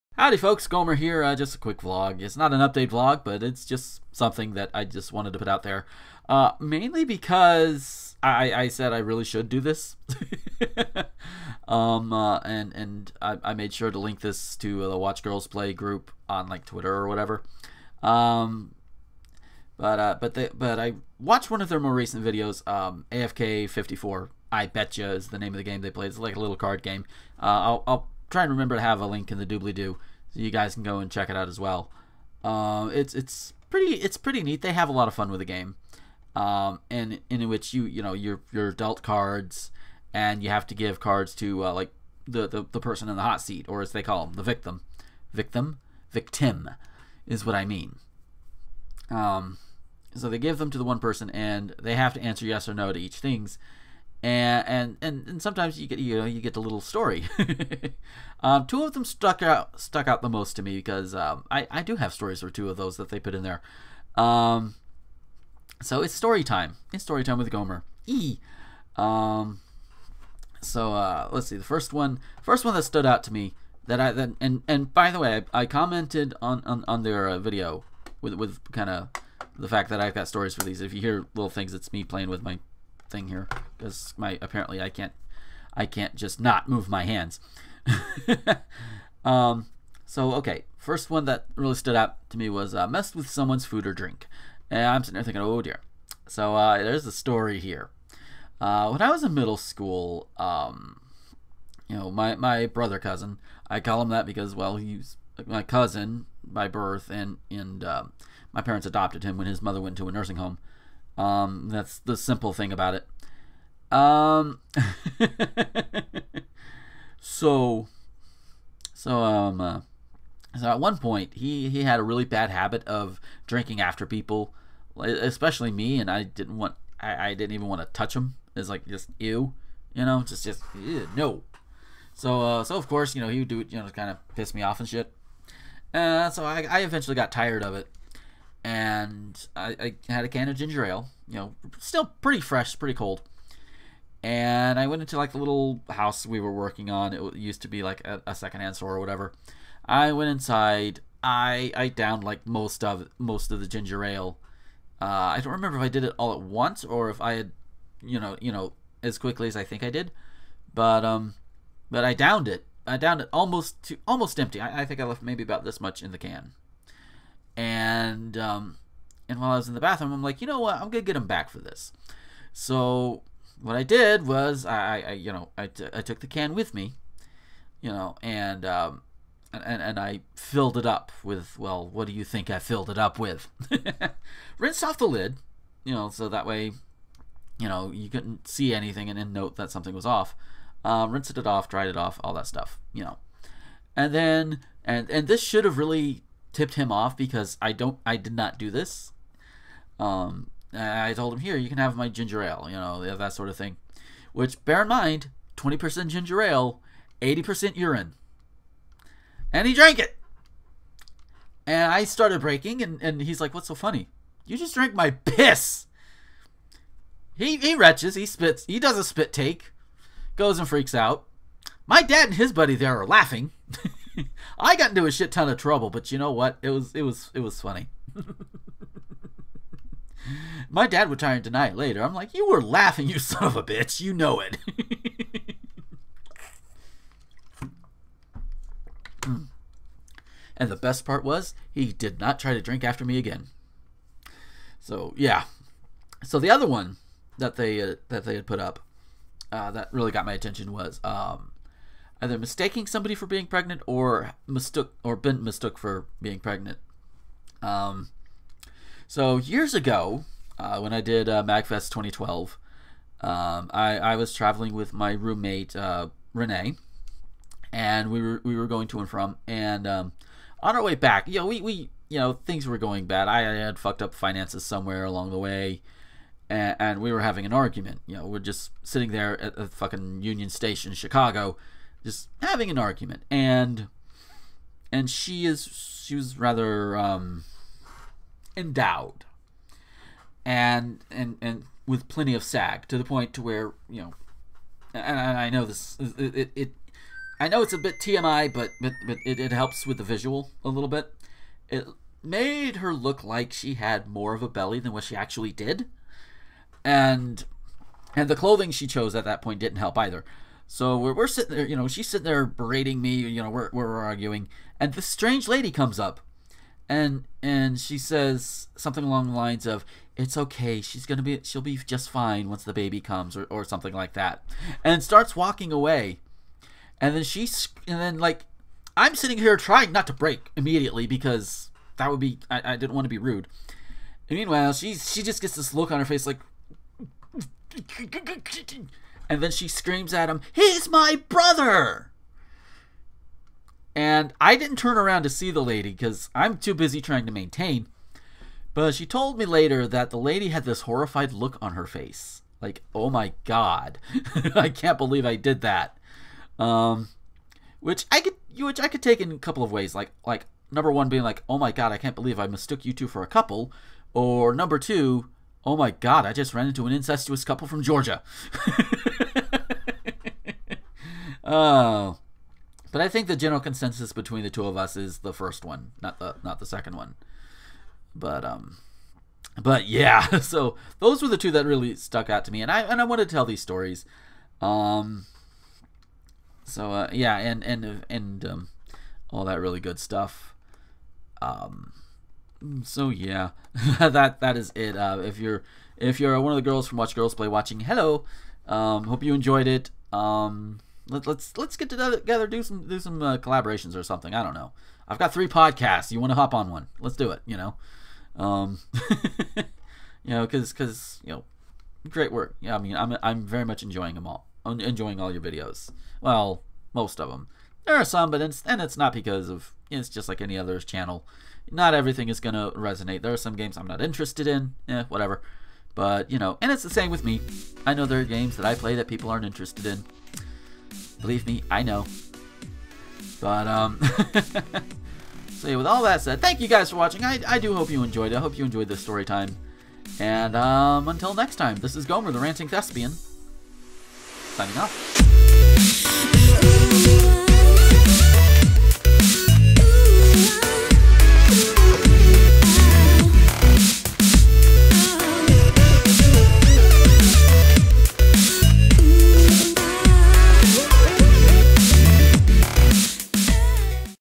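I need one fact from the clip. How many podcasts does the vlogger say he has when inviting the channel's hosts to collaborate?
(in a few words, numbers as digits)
3.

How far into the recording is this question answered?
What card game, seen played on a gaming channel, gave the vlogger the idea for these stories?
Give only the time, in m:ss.
0:23.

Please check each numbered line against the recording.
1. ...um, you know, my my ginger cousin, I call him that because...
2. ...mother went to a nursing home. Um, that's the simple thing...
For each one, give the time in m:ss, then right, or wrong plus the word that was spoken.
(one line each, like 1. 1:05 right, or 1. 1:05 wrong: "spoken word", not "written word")
1. 1:40 wrong: "brother", not "ginger"
2. 1:49 right.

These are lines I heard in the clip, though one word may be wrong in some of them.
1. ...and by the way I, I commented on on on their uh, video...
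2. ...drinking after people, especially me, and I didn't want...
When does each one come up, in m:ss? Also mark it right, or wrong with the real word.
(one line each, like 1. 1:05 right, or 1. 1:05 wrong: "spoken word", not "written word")
1. 1:14 right
2. 2:03 right.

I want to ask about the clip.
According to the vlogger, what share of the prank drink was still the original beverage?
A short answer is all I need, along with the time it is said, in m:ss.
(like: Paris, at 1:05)
20 percent, at 3:25.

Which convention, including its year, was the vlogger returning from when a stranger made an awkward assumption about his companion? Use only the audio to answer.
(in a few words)
Magfest 2012.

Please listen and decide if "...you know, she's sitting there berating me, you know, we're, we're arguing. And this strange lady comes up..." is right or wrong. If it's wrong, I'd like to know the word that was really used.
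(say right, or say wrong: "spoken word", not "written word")
right.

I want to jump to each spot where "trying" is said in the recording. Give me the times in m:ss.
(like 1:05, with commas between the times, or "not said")
5:29, 5:46.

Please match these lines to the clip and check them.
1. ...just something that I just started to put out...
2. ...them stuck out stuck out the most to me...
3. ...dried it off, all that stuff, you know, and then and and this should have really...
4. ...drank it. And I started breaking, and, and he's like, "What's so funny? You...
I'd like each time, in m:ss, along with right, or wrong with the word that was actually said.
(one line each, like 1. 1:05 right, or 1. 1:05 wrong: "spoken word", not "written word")
1. 0:03 wrong: "wanted", not "started"
2. 0:58 right
3. 3:11 right
4. 3:29 right.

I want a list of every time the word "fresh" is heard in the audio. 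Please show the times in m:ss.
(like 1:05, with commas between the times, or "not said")
2:22.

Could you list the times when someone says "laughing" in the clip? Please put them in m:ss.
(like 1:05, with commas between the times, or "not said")
3:43, 3:52.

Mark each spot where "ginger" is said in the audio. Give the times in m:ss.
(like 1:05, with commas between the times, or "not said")
2:20, 2:33, 3:22, 3:26.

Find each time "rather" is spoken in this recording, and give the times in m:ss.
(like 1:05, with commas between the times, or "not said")
4:46.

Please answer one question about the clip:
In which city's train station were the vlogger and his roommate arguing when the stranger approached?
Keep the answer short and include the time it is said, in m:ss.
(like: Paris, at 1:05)
Chicago, at 4:40.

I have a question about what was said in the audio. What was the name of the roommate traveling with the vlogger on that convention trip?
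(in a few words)
Renee.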